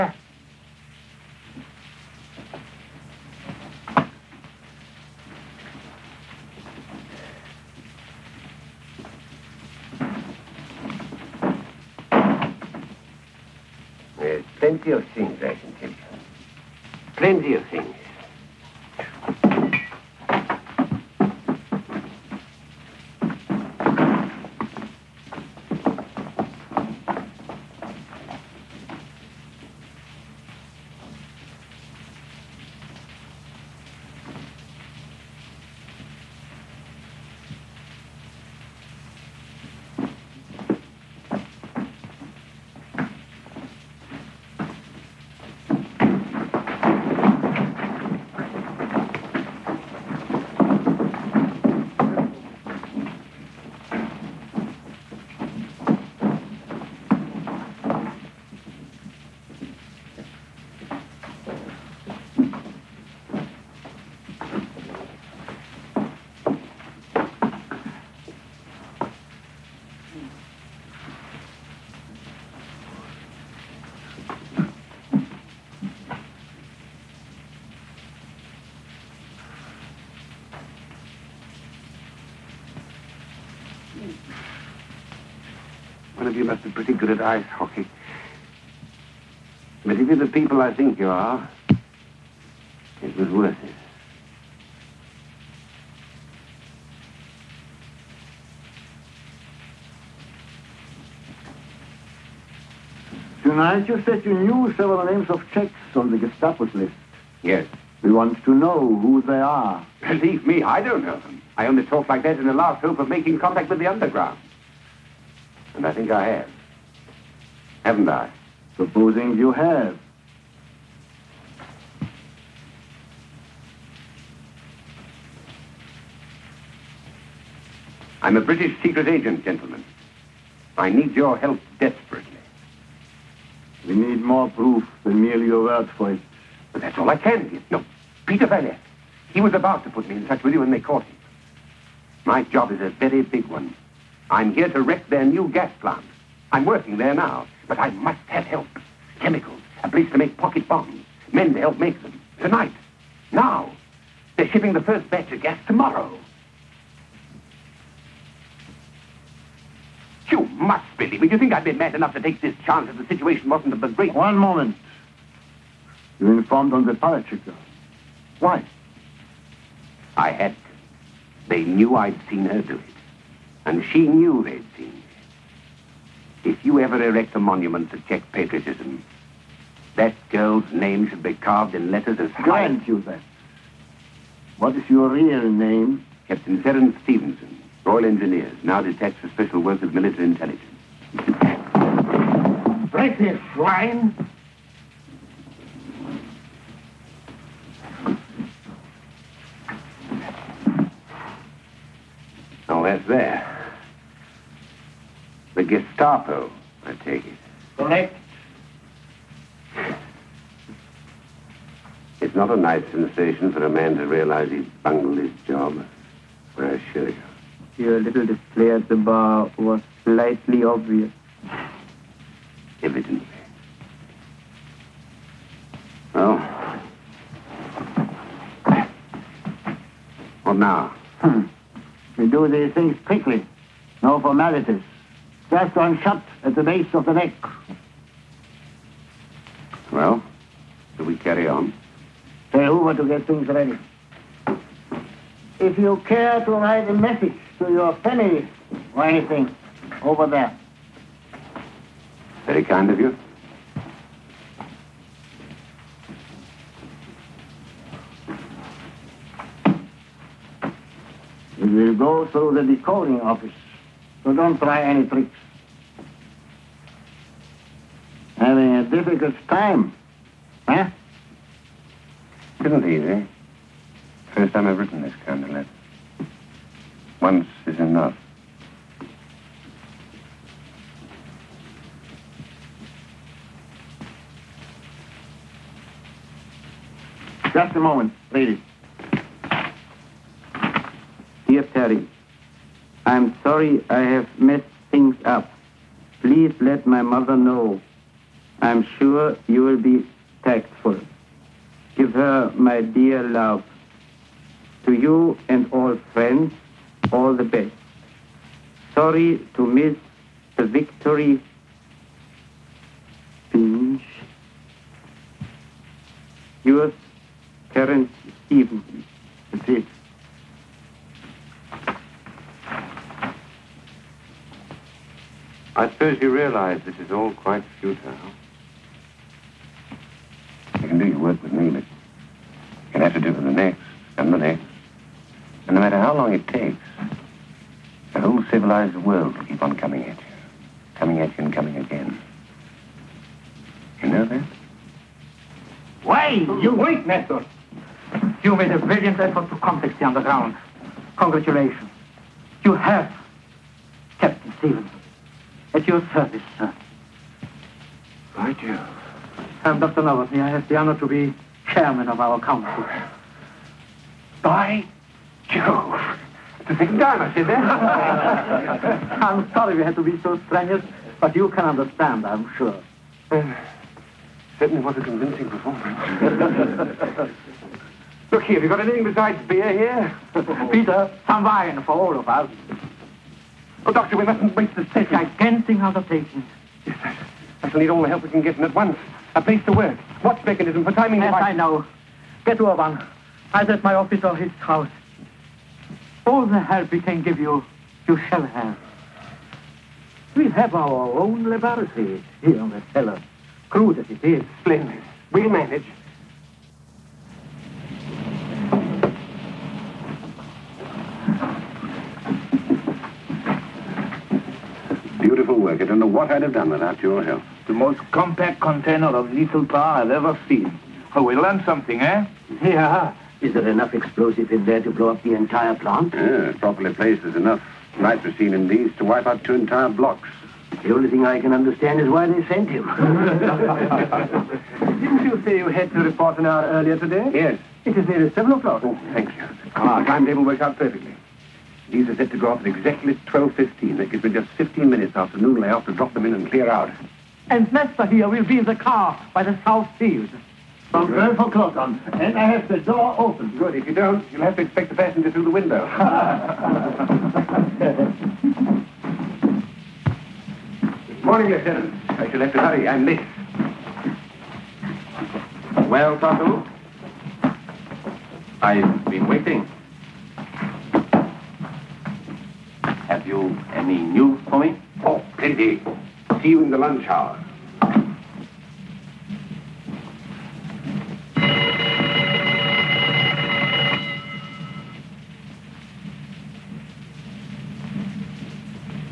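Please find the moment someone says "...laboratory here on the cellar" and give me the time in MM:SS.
06:41.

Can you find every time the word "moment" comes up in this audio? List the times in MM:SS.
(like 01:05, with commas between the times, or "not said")
02:44, 04:47.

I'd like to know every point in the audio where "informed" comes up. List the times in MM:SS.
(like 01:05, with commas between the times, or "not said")
02:46.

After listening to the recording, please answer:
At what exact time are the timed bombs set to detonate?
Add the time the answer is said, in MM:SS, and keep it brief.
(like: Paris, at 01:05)
12:15, at 07:23.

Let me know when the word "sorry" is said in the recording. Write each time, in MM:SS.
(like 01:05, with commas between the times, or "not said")
04:53, 05:08, 06:09.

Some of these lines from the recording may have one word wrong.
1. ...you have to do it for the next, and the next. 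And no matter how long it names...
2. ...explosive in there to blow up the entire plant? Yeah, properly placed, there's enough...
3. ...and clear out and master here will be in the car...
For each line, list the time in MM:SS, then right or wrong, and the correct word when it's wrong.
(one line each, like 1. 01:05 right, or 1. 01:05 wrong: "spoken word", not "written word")
1. 05:32 wrong: "takes", not "names"
2. 07:03 right
3. 07:26 right.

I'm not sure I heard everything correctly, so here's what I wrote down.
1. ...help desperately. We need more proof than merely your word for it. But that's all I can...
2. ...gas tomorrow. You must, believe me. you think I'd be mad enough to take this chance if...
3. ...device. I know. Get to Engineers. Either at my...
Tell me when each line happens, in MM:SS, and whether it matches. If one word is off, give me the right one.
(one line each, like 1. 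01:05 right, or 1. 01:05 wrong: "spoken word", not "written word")
1. 02:11 right
2. 02:35 right
3. 06:31 wrong: "Urban", not "Engineers".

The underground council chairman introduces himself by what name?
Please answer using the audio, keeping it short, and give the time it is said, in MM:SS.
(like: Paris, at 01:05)
Dr. Novotny, at 05:59.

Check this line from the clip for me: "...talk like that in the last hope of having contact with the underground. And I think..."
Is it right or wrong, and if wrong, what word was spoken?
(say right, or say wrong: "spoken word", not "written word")
wrong: "making", not "having".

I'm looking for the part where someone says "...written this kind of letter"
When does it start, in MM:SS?
04:34.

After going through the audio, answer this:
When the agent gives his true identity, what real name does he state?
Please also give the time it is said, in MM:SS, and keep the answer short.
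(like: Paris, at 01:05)
Terence Stevenson, at 03:06.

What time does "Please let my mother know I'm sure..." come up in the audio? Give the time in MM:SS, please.
04:56.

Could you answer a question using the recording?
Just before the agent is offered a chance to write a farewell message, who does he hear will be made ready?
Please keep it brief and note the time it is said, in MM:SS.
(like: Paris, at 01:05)
Hoover, at 04:02.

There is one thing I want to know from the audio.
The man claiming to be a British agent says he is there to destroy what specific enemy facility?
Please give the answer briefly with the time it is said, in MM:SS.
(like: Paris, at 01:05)
new gas plant, at 02:25.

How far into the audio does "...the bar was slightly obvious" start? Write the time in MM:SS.
03:38.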